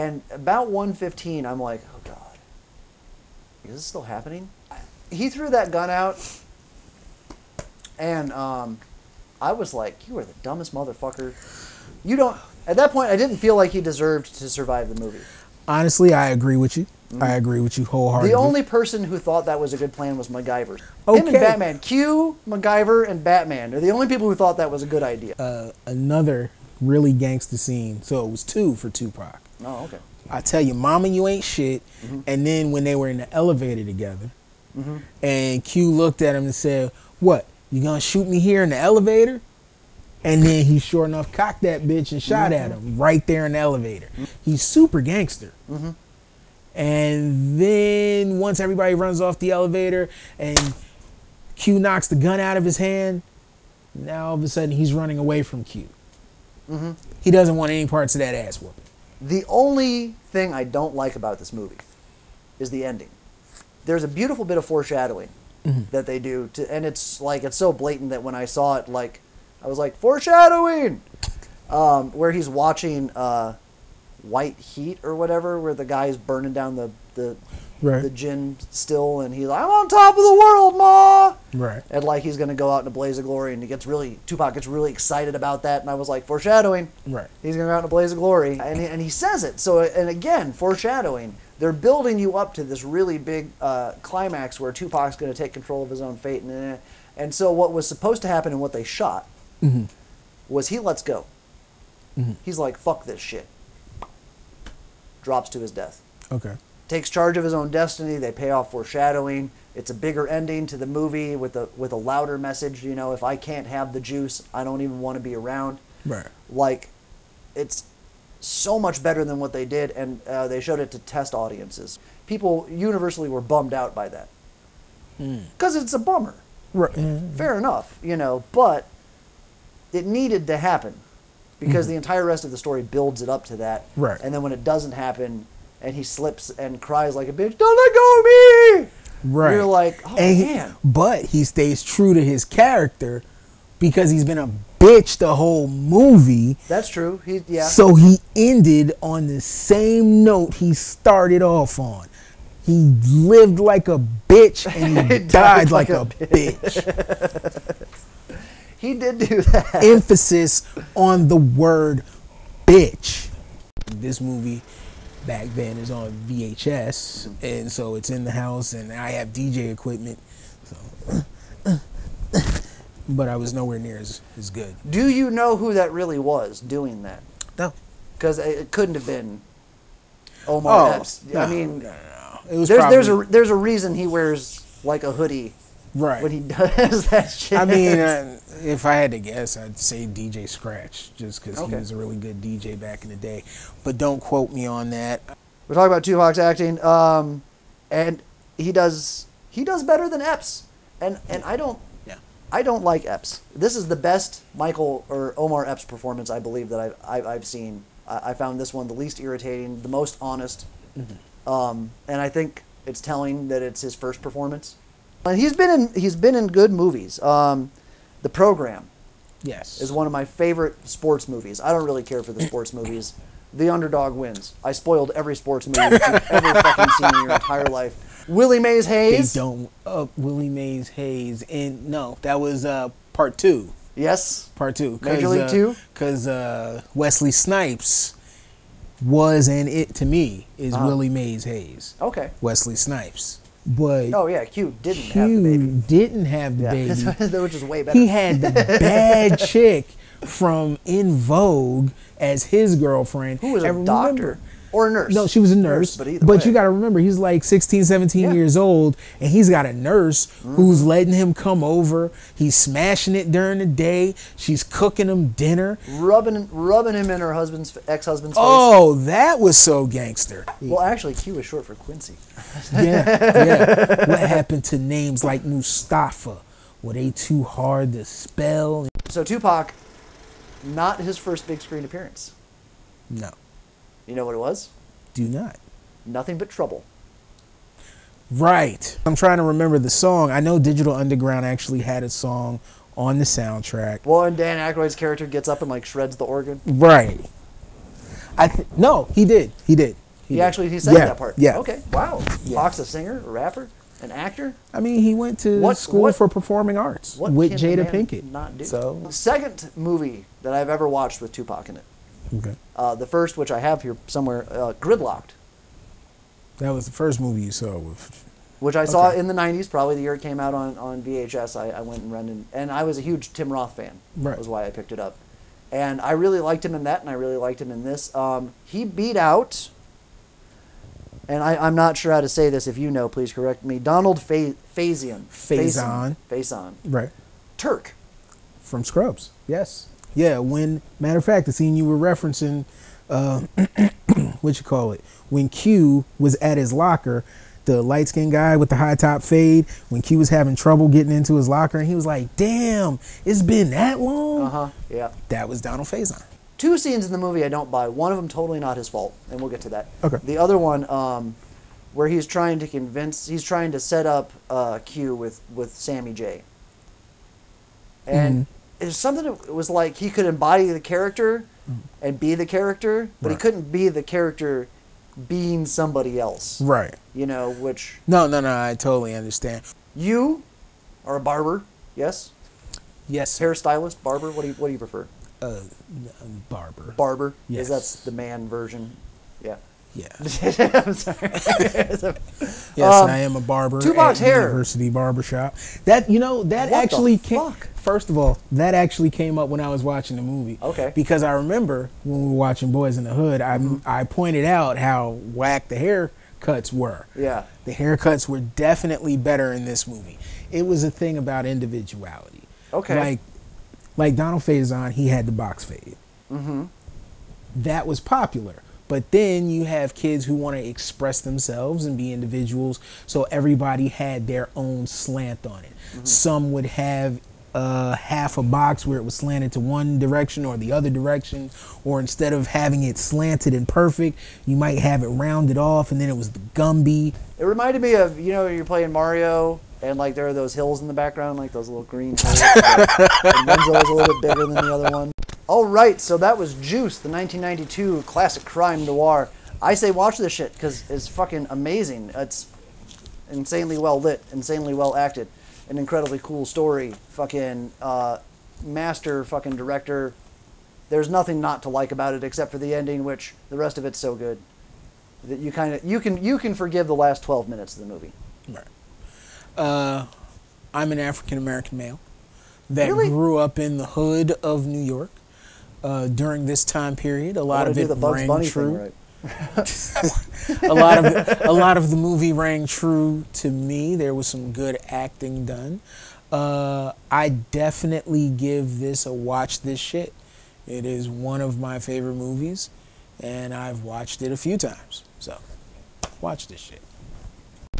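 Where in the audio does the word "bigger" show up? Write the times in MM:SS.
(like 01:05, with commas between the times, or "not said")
01:49, 07:24.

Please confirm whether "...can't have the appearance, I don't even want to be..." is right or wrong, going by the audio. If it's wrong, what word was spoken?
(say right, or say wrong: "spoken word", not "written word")
wrong: "juice", not "appearance".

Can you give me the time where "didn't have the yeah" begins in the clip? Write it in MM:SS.
04:05.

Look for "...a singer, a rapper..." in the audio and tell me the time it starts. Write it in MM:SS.
05:02.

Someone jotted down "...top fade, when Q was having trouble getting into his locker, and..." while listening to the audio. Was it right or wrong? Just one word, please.
right.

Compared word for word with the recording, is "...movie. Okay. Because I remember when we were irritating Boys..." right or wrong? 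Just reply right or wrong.
wrong.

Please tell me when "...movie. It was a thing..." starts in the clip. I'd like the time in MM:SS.
06:49.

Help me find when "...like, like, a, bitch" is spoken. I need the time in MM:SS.
02:35.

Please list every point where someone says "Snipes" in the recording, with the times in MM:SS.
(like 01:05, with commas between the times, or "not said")
03:57, 04:02.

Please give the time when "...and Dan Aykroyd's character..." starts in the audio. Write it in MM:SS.
04:54.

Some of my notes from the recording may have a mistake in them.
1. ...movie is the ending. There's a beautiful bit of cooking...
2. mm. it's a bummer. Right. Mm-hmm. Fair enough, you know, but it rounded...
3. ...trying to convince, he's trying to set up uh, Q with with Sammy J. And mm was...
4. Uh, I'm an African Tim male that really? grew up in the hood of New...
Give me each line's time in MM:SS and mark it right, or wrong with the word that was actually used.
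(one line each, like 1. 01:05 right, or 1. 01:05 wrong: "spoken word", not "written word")
1. 01:01 wrong: "foreshadowing", not "cooking"
2. 02:05 wrong: "needed", not "rounded"
3. 06:02 right
4. 07:49 wrong: "American", not "Tim".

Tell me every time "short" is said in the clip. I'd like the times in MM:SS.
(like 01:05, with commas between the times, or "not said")
04:31.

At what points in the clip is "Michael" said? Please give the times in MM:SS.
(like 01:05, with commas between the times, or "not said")
03:24.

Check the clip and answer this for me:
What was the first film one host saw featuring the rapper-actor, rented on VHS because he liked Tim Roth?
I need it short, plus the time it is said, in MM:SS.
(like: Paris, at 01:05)
Gridlocked, at 05:14.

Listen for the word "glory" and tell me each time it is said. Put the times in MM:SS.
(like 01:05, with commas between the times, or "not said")
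01:23, 01:28.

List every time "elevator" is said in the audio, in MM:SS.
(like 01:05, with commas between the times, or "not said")
00:33, 00:38, 00:43, 00:49.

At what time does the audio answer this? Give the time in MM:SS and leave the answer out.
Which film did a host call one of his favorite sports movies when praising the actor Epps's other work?
03:38.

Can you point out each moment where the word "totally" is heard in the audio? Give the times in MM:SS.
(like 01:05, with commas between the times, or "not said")
05:58, 06:18.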